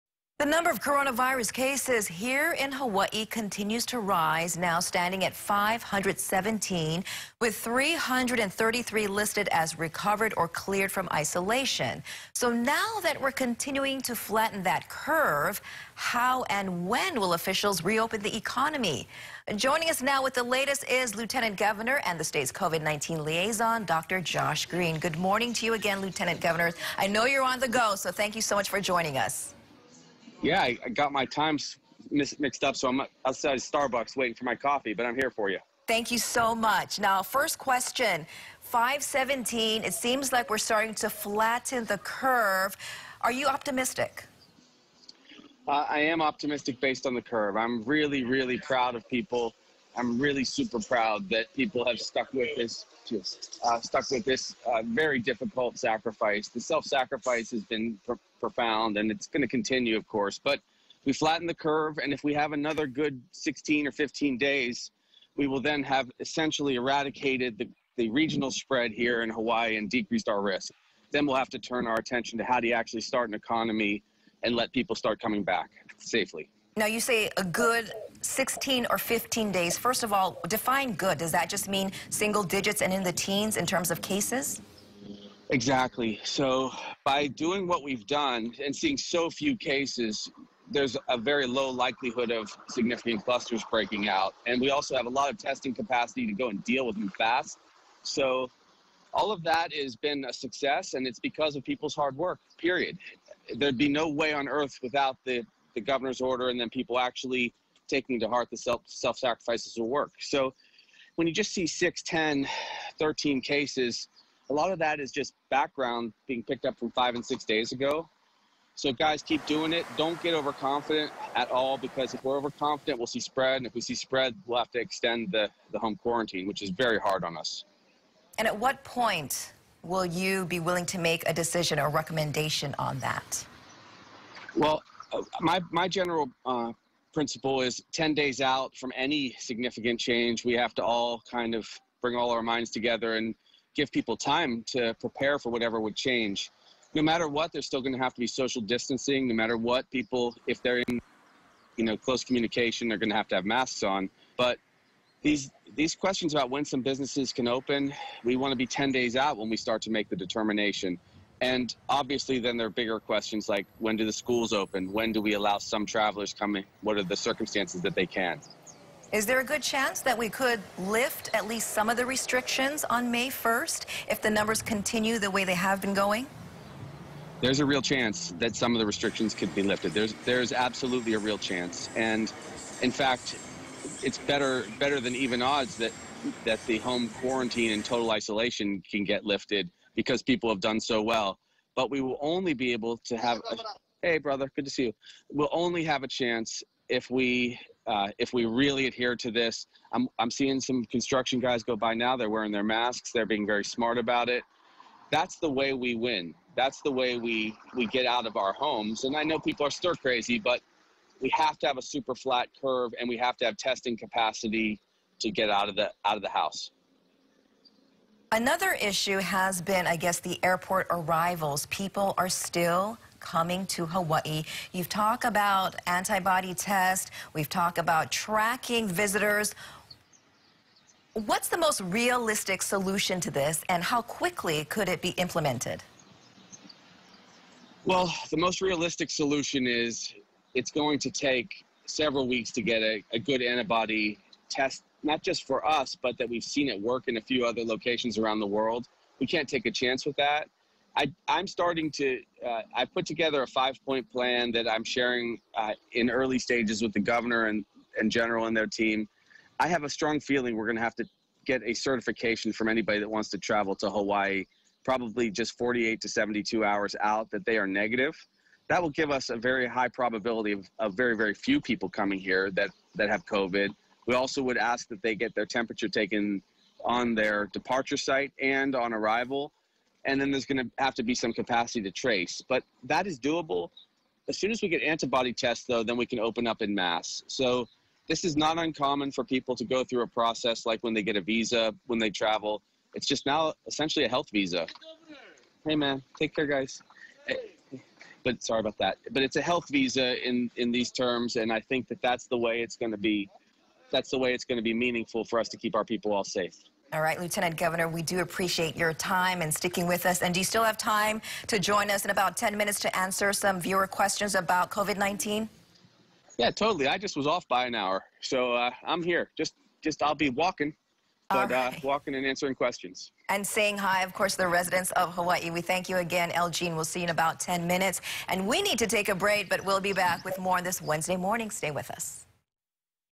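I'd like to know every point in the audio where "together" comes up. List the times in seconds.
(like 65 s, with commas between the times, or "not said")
142 s, 253 s.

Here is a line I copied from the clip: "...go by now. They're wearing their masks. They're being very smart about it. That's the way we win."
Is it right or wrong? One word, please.
right.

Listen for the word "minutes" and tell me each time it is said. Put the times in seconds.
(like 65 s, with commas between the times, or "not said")
312 s, 327 s.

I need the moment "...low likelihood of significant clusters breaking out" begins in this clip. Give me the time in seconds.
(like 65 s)
91 s.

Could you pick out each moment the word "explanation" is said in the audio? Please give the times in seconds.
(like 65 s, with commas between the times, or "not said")
not said.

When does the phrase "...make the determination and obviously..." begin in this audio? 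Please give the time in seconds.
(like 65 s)
159 s.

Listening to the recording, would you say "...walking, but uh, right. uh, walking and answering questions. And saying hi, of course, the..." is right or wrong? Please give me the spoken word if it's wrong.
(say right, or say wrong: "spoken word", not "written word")
right.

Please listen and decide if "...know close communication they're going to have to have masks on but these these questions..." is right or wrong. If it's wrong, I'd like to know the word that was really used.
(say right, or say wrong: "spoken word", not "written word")
right.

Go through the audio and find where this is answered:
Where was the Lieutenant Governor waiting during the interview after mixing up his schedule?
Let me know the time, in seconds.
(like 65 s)
33 s.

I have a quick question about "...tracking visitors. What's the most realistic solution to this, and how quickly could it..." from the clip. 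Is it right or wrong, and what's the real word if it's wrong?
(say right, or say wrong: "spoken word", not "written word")
right.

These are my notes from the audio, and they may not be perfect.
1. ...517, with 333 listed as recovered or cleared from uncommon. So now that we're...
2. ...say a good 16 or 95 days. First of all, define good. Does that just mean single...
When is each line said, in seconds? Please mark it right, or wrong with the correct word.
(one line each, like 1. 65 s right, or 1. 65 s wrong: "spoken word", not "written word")
1. 5 s wrong: "isolation", not "uncommon"
2. 77 s wrong: "15", not "95".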